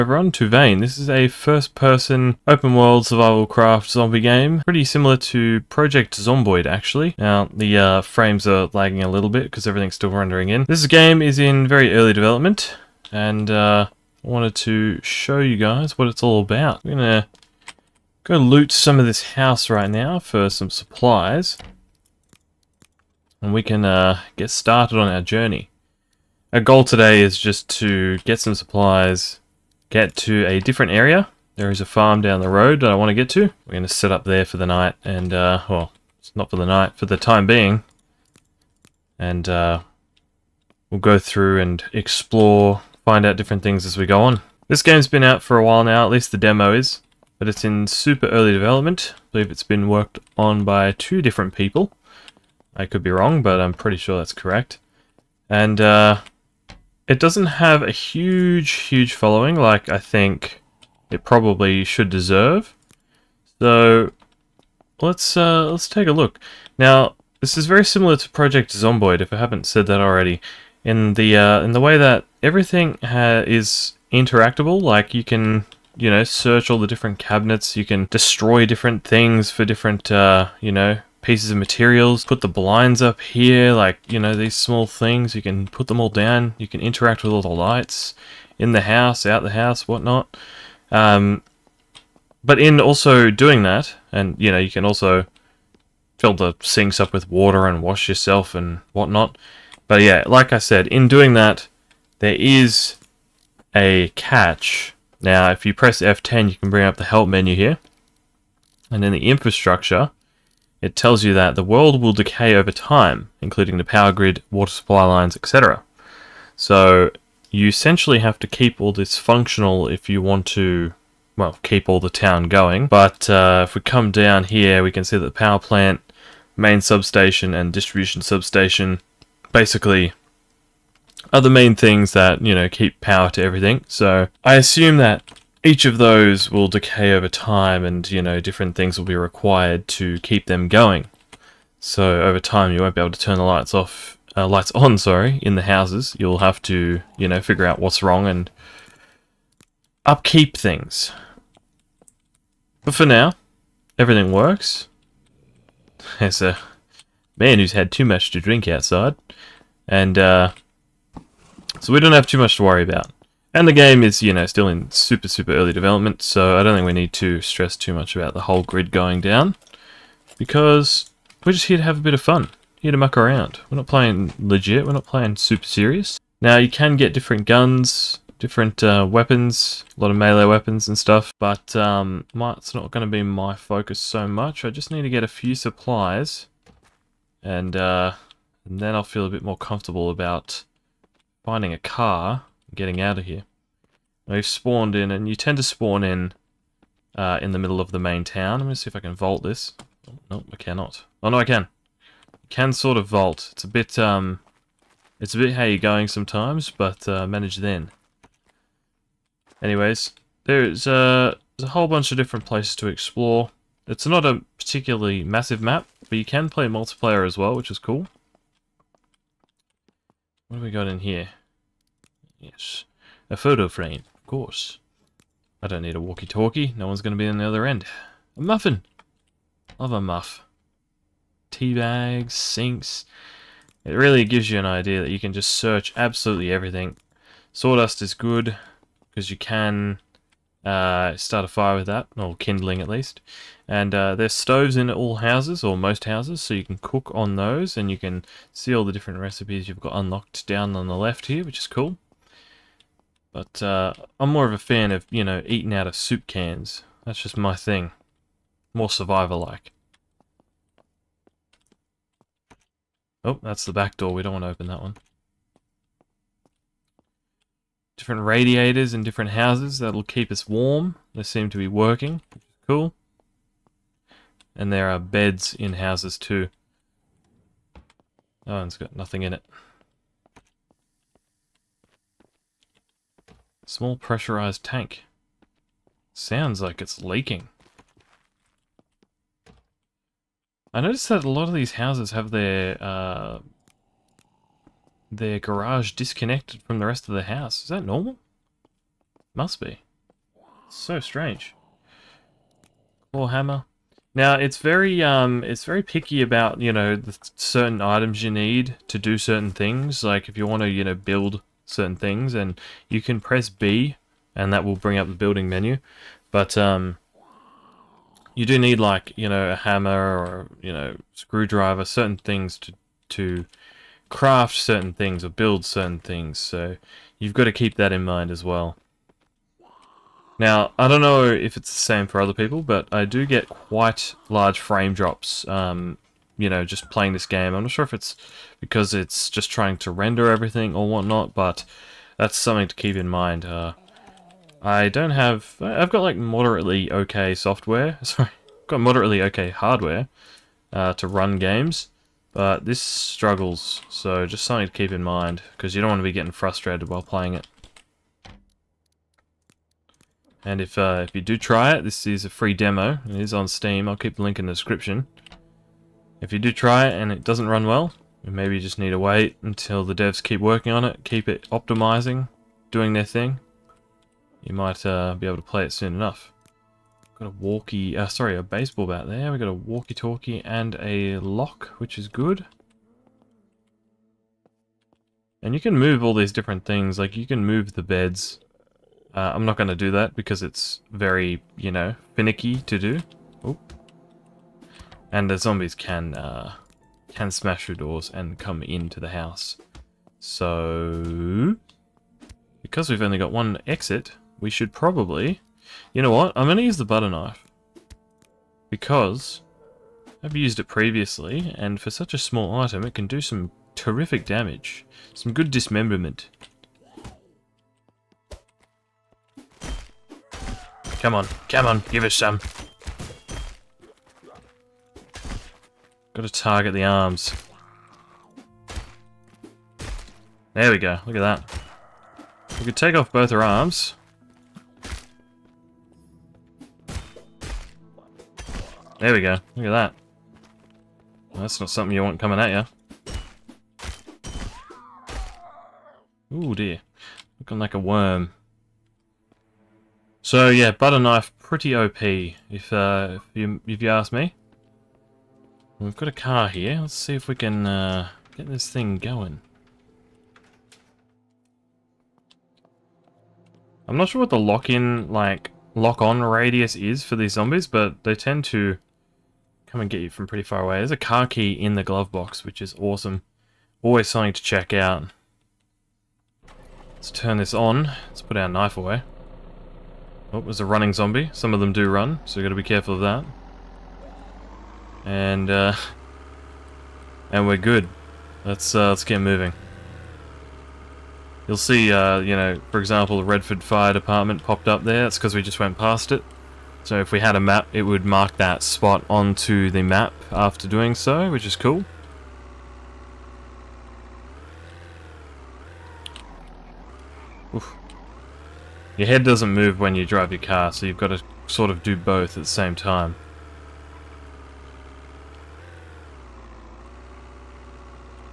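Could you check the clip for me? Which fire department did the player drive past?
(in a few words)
Redford Fire Department.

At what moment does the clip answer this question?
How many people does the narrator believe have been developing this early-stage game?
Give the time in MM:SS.
00:50.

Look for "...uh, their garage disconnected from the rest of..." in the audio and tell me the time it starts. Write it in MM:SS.
04:52.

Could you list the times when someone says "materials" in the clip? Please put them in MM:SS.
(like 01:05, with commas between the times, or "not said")
01:21.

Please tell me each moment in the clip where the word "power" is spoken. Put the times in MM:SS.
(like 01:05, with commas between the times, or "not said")
01:53, 02:05, 02:12.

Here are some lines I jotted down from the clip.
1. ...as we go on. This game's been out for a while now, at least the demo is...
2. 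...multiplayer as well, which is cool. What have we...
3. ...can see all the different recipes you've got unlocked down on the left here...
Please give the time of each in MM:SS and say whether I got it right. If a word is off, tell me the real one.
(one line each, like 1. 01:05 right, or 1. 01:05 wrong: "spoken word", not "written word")
1. 00:43 right
2. 03:36 right
3. 04:07 right.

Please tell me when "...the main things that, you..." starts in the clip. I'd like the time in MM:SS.
02:11.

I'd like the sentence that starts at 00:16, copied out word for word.
We're gonna go loot some of this house right now for some supplies, and we can uh, get started on our journey.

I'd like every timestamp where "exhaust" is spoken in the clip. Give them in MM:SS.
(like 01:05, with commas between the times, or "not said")
not said.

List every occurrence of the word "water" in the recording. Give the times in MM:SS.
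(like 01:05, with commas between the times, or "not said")
01:37, 01:54.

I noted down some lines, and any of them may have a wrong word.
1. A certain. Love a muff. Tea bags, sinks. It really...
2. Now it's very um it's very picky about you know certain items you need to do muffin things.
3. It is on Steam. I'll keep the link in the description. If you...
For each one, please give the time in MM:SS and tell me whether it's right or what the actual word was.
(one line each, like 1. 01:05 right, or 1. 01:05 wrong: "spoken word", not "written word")
1. 03:48 wrong: "muffin", not "certain"
2. 05:04 wrong: "certain", not "muffin"
3. 06:03 right.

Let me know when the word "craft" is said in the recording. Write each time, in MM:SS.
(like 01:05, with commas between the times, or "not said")
00:03, 05:24.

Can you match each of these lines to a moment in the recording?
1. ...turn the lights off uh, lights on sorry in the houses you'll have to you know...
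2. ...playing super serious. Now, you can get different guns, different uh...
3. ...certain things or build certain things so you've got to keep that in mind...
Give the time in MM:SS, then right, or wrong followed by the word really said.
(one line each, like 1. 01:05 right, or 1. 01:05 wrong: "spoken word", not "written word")
1. 02:23 right
2. 02:55 right
3. 05:24 right.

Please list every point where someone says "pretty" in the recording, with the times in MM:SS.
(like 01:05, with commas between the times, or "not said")
00:04, 00:53, 07:31, 07:50.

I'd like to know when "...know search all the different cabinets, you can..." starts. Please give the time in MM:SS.
01:16.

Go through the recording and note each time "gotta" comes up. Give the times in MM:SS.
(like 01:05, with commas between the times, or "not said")
07:06, 08:02.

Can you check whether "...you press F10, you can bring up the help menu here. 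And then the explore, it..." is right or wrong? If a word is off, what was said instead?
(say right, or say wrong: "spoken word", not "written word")
wrong: "infrastructure", not "explore".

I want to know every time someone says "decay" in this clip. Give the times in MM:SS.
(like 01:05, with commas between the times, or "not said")
01:52, 02:16.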